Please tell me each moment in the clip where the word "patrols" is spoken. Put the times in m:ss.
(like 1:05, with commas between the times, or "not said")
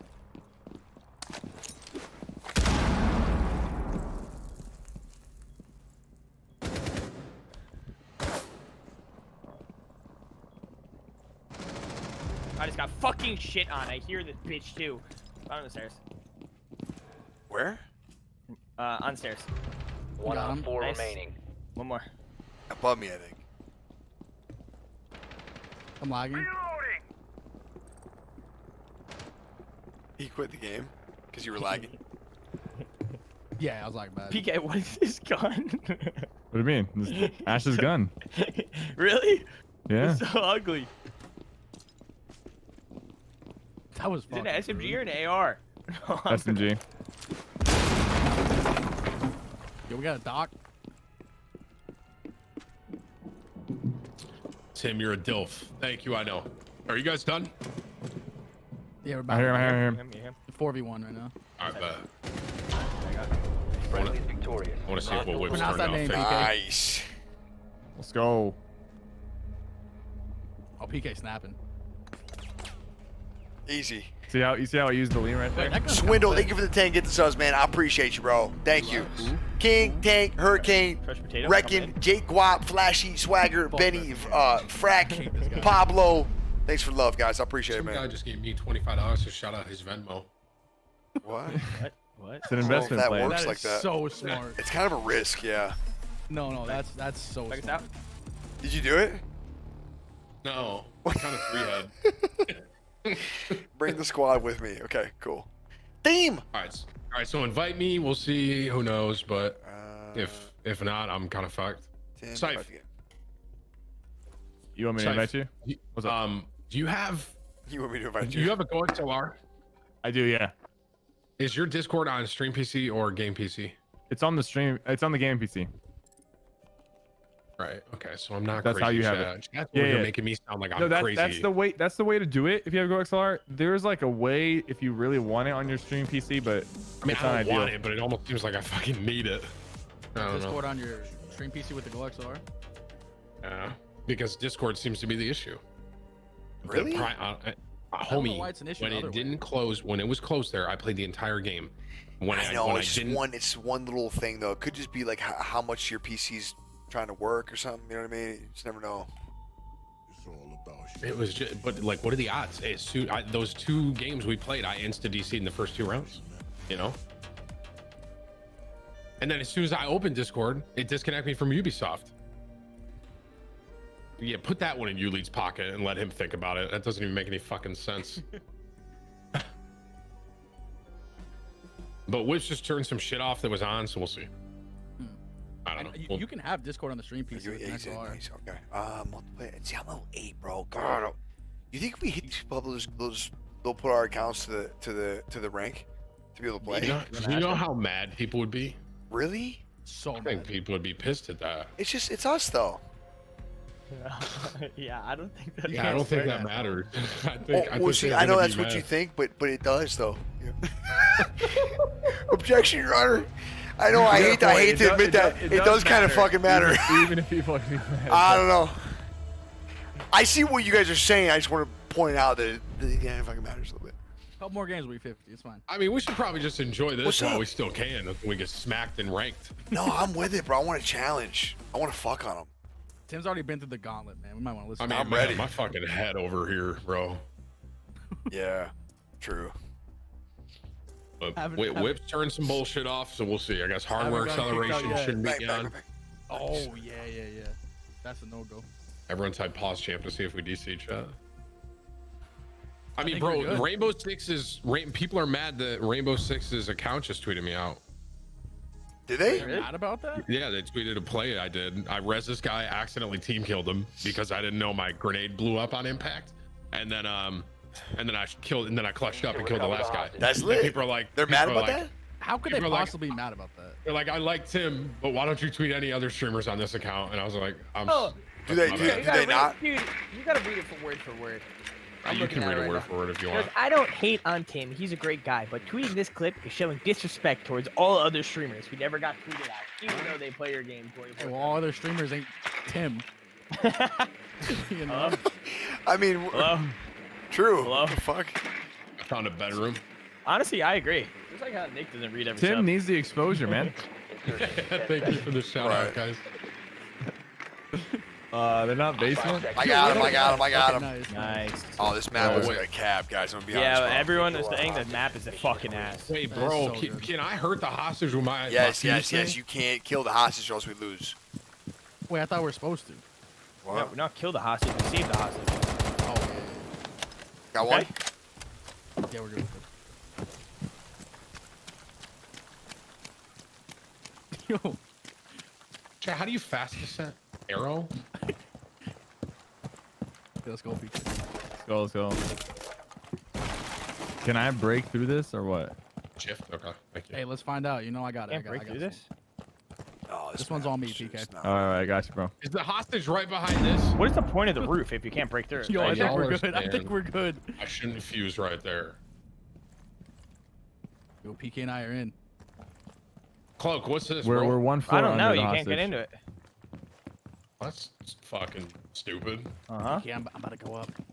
not said.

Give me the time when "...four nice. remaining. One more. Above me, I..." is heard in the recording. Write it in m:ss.
0:20.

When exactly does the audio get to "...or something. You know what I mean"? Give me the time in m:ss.
2:37.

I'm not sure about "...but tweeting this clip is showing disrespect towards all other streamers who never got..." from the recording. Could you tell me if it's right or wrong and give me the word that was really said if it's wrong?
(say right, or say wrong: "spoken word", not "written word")
right.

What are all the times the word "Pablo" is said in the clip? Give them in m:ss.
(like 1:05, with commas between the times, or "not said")
1:25.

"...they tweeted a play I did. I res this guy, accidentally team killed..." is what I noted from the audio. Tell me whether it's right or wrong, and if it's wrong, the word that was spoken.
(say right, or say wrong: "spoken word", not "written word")
right.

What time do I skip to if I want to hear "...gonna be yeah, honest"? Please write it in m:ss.
5:13.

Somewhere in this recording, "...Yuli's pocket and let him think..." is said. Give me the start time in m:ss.
2:54.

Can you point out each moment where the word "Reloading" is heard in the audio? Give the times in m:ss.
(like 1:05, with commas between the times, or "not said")
0:26.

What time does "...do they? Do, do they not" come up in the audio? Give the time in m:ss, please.
4:38.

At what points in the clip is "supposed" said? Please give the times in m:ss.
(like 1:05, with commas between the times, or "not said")
5:22.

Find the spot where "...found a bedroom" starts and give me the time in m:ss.
4:59.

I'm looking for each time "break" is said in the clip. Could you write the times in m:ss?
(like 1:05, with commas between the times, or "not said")
5:44, 5:48, 5:55.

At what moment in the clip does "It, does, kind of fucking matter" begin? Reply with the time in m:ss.
3:35.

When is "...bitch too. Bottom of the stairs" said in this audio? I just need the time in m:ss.
0:14.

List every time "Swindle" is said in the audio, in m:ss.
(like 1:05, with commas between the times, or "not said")
1:15.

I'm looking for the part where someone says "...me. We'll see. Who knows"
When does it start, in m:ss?
1:47.